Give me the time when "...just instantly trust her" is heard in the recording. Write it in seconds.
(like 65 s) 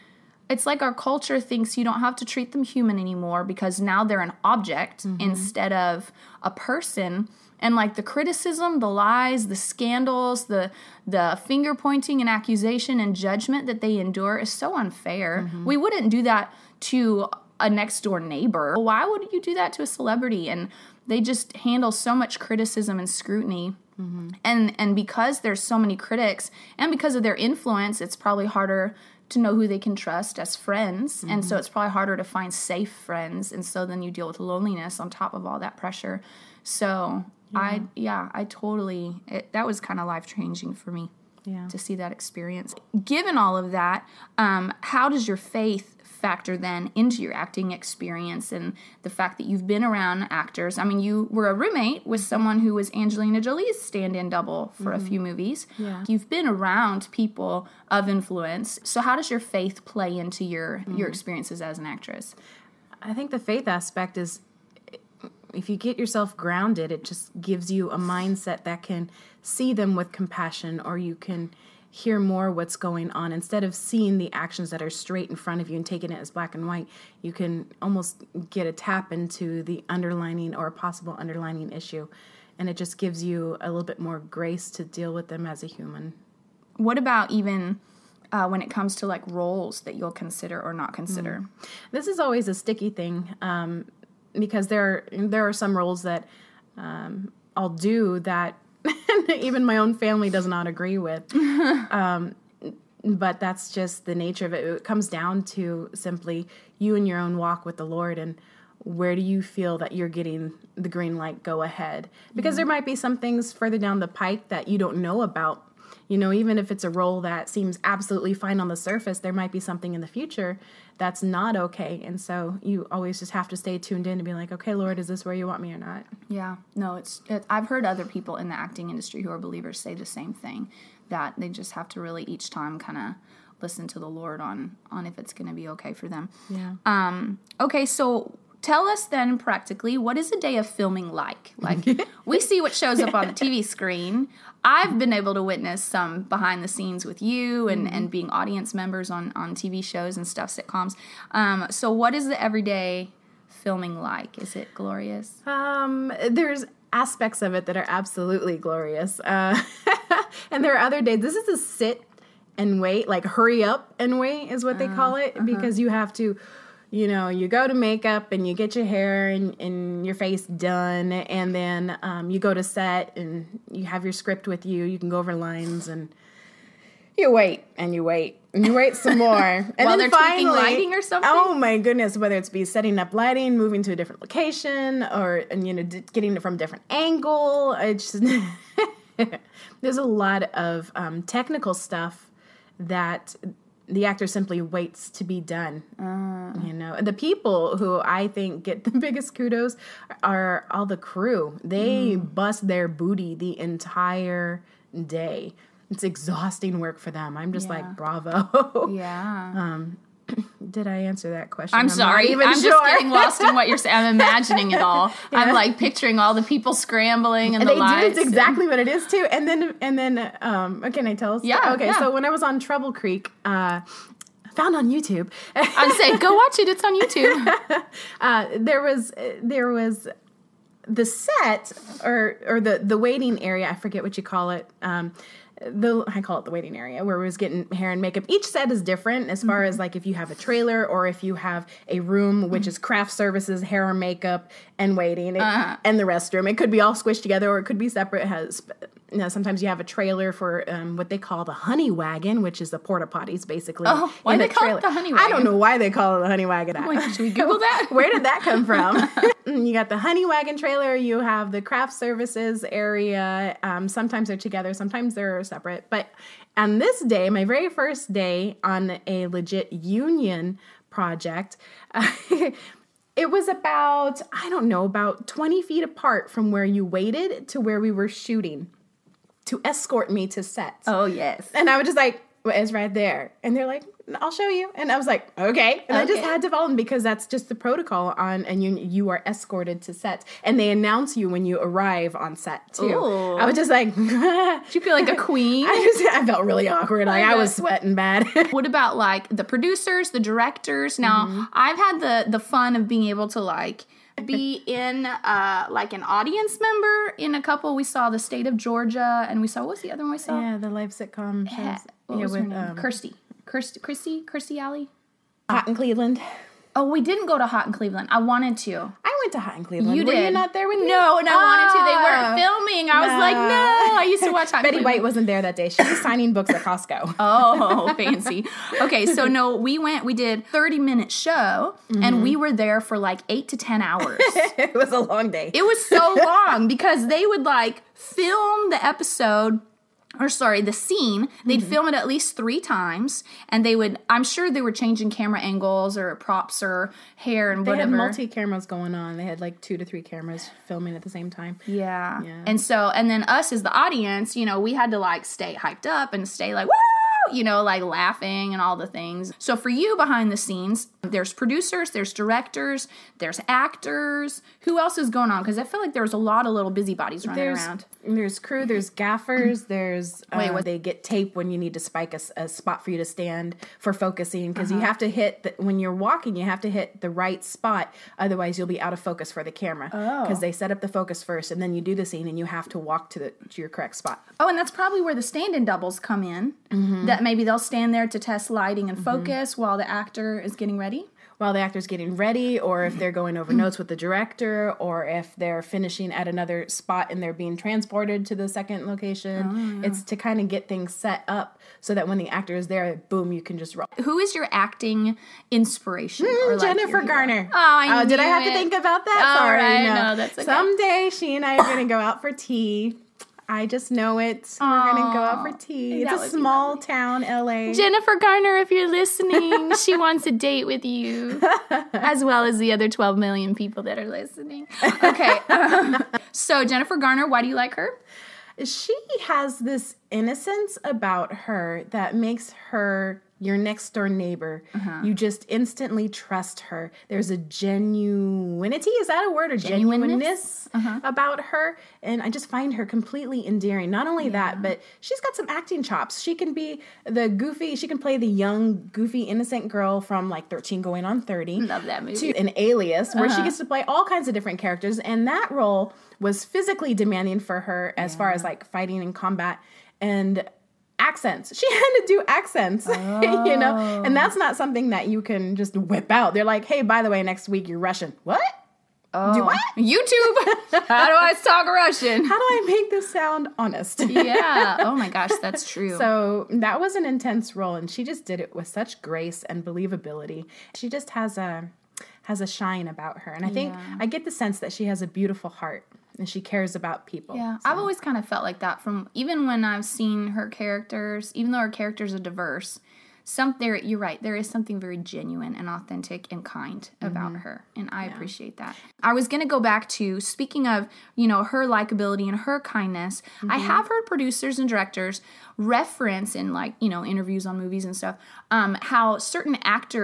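435 s.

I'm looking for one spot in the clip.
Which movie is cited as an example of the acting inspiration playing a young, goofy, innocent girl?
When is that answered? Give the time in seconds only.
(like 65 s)
450 s.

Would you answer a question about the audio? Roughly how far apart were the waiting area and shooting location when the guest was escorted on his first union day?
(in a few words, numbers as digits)
20 feet.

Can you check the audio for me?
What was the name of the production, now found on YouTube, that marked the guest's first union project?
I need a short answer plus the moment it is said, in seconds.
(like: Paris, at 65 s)
Trouble Creek, at 222 s.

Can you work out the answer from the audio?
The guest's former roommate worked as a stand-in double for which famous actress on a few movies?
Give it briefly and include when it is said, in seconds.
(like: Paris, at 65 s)
Angelina Jolie, at 52 s.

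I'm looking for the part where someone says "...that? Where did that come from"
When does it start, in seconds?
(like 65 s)
257 s.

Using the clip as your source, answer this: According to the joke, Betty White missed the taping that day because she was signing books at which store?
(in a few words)
Costco.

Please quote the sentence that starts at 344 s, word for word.
I'm sure they were changing camera angles or props or hair and they whatever.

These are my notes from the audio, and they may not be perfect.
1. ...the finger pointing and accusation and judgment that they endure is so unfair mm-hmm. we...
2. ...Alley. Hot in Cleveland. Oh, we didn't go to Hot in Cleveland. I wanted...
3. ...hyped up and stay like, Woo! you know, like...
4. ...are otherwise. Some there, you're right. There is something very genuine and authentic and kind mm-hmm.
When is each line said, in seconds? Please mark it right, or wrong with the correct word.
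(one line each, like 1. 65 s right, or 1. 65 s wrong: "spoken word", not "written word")
1. 11 s right
2. 314 s right
3. 355 s right
4. 492 s wrong: "diverse", not "otherwise".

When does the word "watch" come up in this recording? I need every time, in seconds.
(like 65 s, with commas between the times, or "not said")
226 s, 324 s.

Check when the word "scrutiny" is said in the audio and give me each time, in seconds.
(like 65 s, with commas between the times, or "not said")
23 s.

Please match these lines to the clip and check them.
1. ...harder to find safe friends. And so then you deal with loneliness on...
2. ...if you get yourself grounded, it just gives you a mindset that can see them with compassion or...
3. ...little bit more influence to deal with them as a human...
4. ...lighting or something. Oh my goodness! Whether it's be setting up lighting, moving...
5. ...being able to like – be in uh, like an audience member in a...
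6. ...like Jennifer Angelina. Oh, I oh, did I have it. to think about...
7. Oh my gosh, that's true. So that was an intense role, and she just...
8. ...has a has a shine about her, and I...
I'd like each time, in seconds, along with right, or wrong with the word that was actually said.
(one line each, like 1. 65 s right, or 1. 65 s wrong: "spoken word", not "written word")
1. 31 s right
2. 65 s right
3. 83 s wrong: "grace", not "influence"
4. 180 s right
5. 302 s right
6. 406 s wrong: "Garner", not "Angelina"
7. 474 s right
8. 481 s right.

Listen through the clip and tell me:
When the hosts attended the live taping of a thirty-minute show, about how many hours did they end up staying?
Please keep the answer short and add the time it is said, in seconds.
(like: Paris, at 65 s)
8 to 10 hours, at 333 s.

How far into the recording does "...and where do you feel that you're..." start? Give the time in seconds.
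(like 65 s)
108 s.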